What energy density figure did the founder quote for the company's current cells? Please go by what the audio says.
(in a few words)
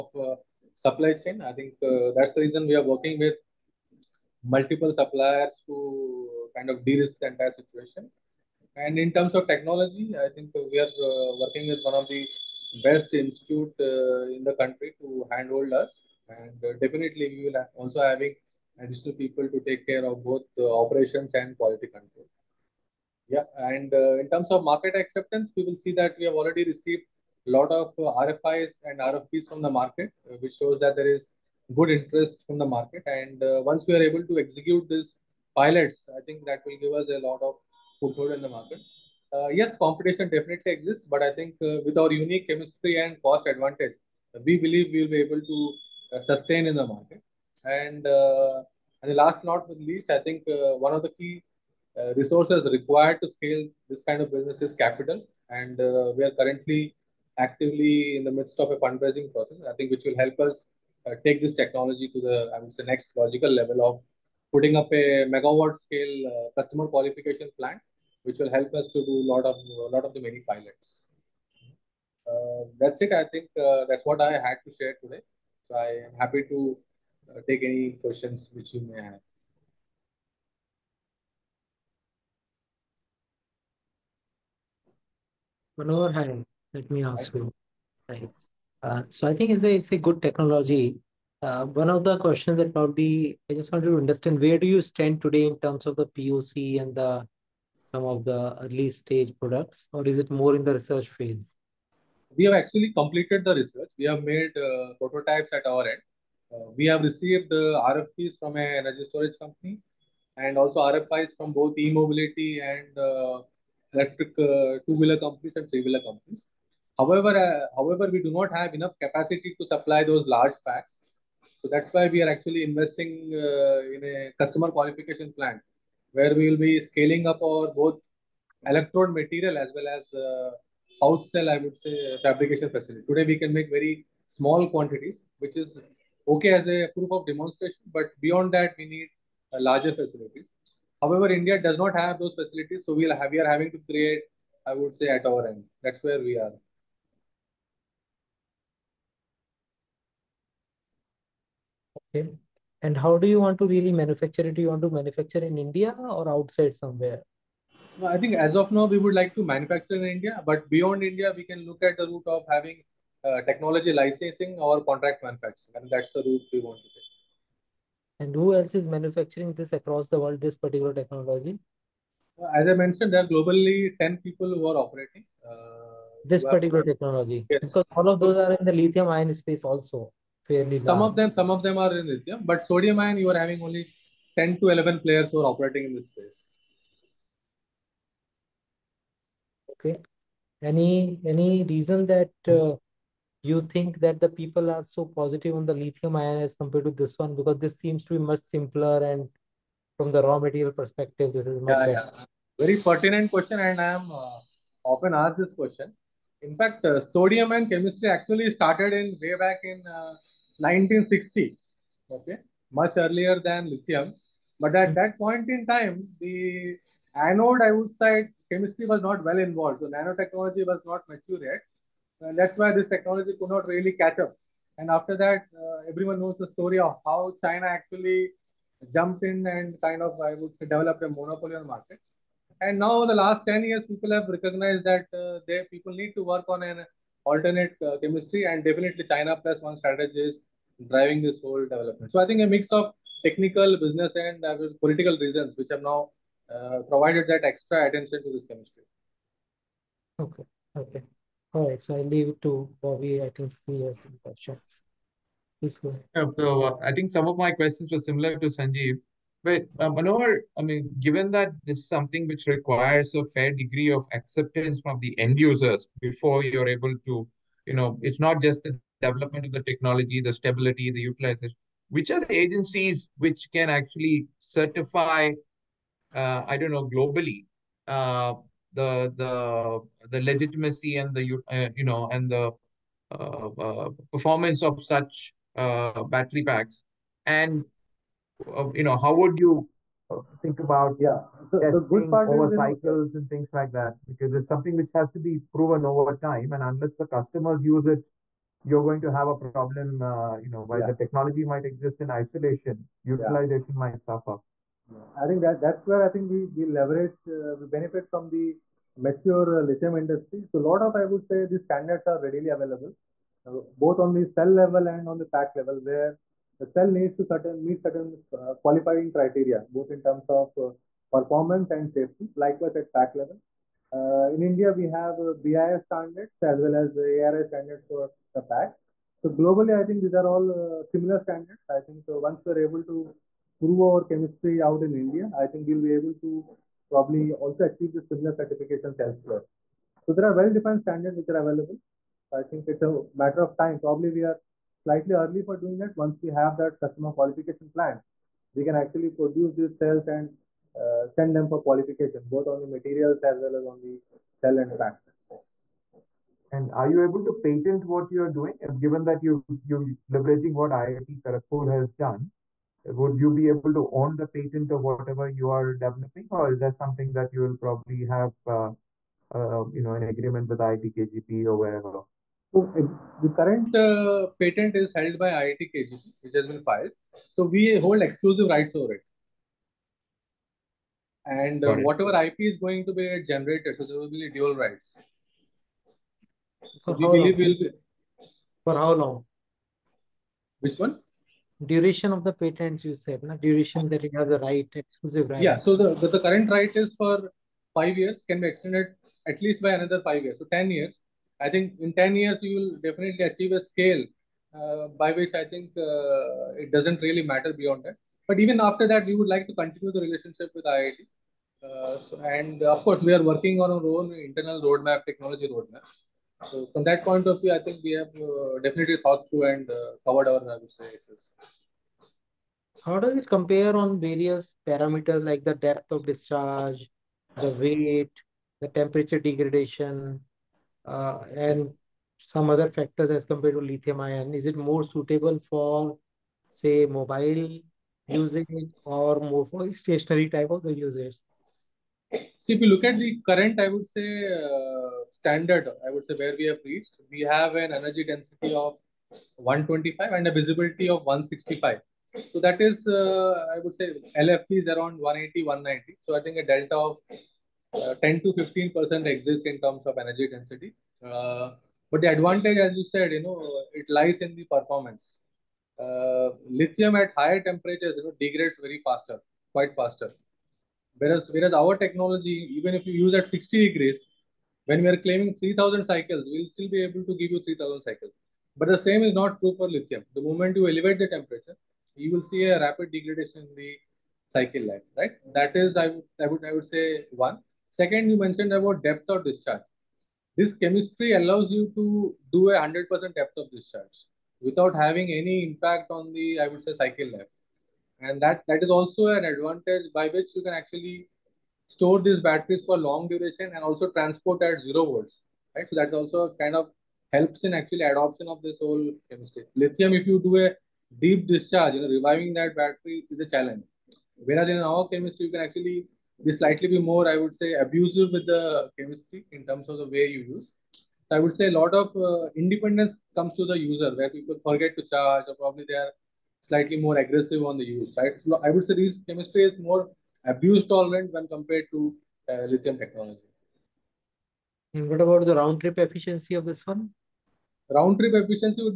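125.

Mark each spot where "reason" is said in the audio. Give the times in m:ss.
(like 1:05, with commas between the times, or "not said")
0:02, 3:11, 4:05.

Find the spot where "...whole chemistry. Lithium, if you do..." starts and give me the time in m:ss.
8:28.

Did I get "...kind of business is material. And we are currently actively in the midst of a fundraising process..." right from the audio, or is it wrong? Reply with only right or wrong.
wrong.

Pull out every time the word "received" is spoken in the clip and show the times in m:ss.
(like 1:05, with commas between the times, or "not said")
0:26, 1:47.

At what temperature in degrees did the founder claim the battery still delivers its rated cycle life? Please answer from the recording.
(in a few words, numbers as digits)
60 degrees.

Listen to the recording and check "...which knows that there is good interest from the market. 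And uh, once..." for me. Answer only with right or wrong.
wrong.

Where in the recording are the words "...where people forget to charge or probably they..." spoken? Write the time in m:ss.
8:43.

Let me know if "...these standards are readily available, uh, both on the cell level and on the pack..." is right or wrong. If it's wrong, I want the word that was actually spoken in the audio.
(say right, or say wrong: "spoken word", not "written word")
right.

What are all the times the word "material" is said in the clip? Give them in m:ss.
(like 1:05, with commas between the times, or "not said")
2:09, 3:20, 5:52.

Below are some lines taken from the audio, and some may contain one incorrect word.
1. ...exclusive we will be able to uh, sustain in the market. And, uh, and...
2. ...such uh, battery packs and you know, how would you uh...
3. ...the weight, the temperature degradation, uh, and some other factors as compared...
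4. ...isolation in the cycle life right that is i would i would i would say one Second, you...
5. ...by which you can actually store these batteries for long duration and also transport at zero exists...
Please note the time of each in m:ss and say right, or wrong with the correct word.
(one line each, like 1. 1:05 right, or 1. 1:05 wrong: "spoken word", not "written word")
1. 0:44 wrong: "believe", not "exclusive"
2. 4:44 right
3. 7:07 right
4. 8:02 wrong: "degradation", not "isolation"
5. 8:19 wrong: "volts", not "exists".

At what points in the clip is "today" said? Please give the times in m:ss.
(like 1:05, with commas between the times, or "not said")
1:15, 1:35, 2:13.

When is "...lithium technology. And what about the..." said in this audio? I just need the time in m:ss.
8:52.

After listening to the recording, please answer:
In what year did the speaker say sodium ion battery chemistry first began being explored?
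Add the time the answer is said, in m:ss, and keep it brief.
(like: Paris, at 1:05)
1960, at 3:30.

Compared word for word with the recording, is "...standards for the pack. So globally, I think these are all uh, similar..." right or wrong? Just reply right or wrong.
right.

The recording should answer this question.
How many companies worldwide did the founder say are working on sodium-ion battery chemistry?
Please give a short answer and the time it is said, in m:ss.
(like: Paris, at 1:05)
10, at 2:53.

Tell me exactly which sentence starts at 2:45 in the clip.
And that's the route we want to take.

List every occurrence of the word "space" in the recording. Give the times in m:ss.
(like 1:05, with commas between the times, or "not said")
2:59, 3:06.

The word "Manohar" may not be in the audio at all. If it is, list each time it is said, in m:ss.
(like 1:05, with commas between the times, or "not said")
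1:25, 4:19.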